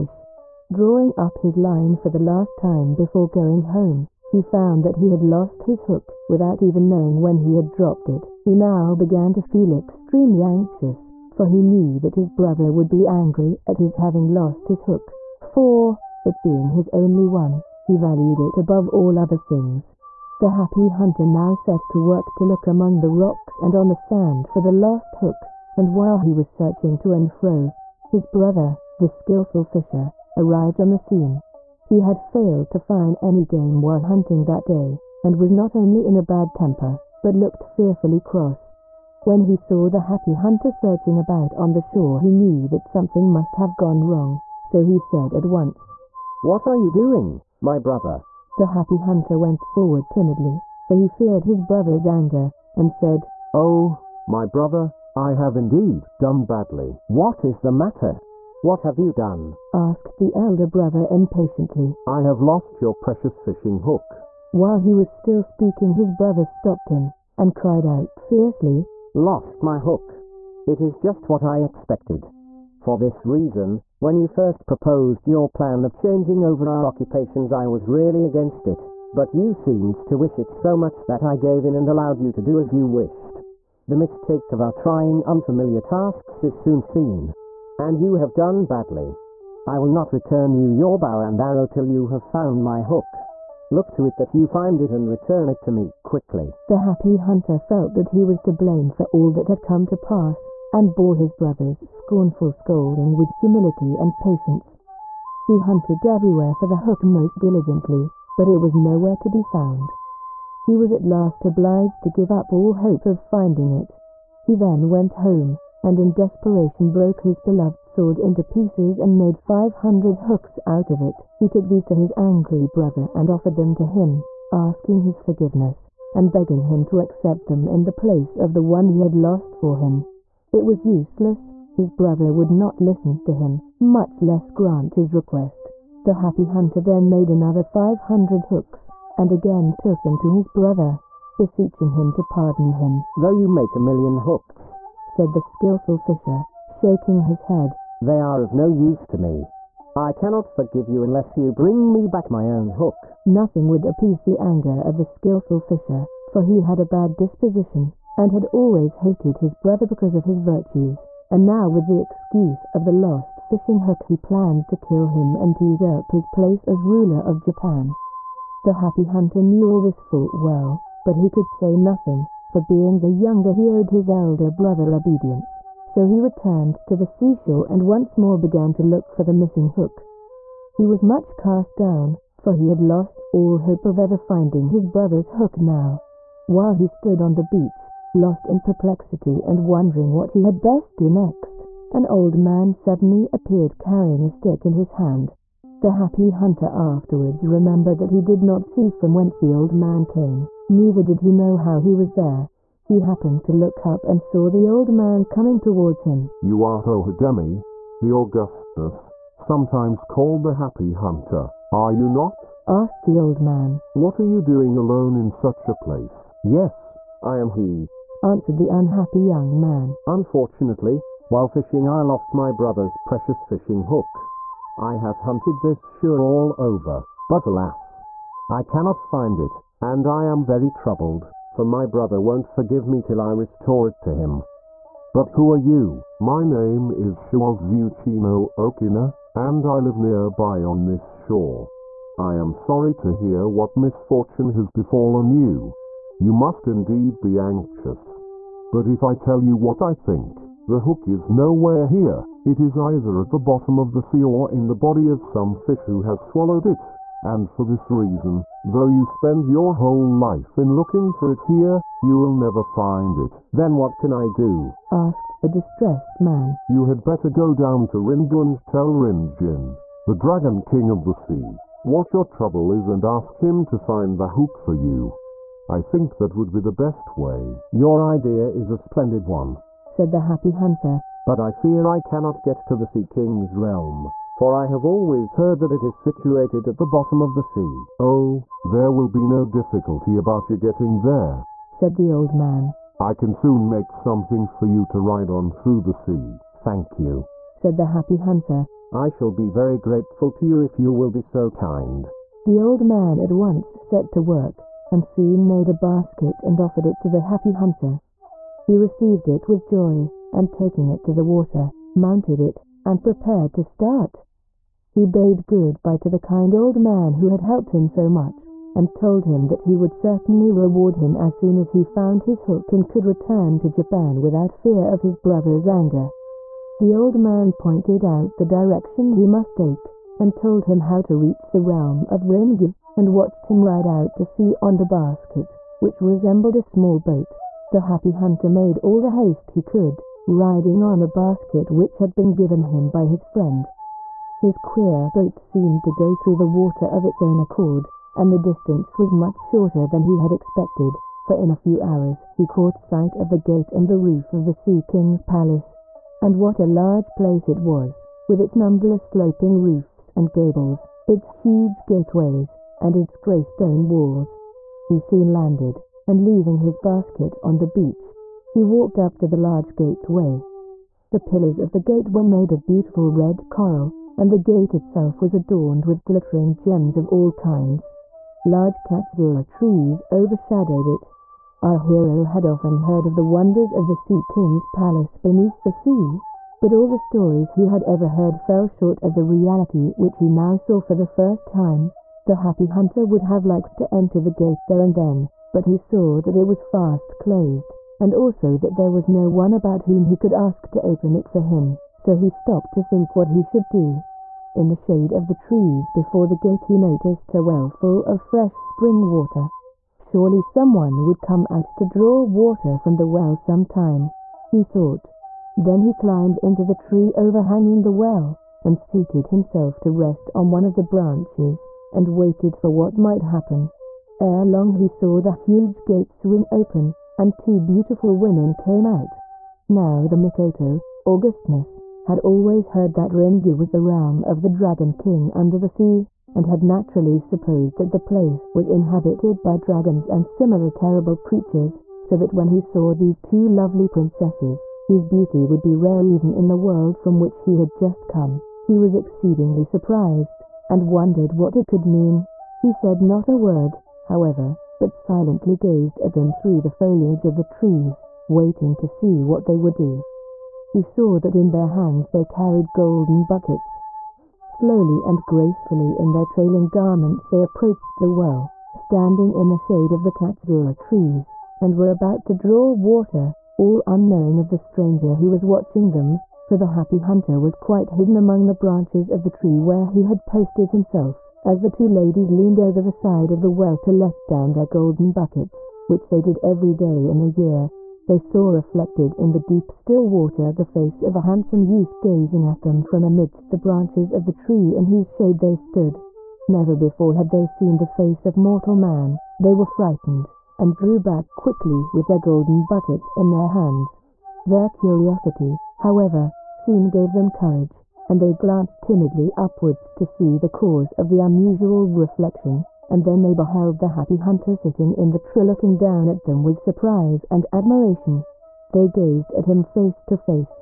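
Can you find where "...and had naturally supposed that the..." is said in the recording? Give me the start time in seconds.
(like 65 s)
436 s.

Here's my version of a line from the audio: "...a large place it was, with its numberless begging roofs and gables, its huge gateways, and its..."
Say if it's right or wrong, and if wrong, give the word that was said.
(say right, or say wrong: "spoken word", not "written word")
wrong: "sloping", not "begging".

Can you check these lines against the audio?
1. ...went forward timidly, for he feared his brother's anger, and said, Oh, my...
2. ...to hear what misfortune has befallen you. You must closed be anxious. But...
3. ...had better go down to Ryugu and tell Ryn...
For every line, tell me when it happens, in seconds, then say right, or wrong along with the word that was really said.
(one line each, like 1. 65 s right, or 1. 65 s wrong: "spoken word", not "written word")
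1. 49 s right
2. 242 s wrong: "indeed", not "closed"
3. 266 s right.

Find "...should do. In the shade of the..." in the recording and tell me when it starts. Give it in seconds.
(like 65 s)
403 s.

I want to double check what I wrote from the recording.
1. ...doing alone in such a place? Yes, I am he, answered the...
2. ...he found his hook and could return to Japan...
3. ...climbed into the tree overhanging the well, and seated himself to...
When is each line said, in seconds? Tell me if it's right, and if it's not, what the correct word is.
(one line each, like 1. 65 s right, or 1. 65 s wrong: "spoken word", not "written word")
1. 214 s right
2. 321 s right
3. 415 s right.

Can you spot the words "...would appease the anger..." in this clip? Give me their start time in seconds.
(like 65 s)
153 s.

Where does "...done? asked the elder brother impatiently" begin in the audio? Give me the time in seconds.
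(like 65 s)
59 s.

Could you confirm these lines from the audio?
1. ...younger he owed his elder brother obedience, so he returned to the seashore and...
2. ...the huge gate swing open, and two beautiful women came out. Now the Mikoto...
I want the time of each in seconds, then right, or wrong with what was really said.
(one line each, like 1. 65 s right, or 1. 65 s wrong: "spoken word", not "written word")
1. 173 s right
2. 425 s right.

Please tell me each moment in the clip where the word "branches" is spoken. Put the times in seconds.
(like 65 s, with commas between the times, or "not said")
420 s, 478 s, 493 s.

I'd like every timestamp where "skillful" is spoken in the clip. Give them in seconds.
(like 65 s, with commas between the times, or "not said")
29 s, 145 s, 155 s.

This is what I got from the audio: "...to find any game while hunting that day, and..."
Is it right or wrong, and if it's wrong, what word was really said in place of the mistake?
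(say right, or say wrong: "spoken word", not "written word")
right.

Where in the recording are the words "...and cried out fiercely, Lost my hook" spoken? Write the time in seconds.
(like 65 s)
67 s.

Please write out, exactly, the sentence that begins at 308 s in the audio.
He received it with joy, and taking it to the water, mounted it, and prepared to start.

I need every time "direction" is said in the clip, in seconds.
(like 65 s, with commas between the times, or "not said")
328 s.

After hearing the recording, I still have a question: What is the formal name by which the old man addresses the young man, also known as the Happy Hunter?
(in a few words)
Hohodemi.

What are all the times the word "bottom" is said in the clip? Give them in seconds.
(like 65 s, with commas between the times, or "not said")
253 s, 286 s.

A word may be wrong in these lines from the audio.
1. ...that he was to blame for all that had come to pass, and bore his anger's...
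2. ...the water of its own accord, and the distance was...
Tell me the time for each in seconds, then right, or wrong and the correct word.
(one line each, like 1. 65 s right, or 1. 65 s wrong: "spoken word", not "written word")
1. 97 s wrong: "brother", not "anger"
2. 346 s right.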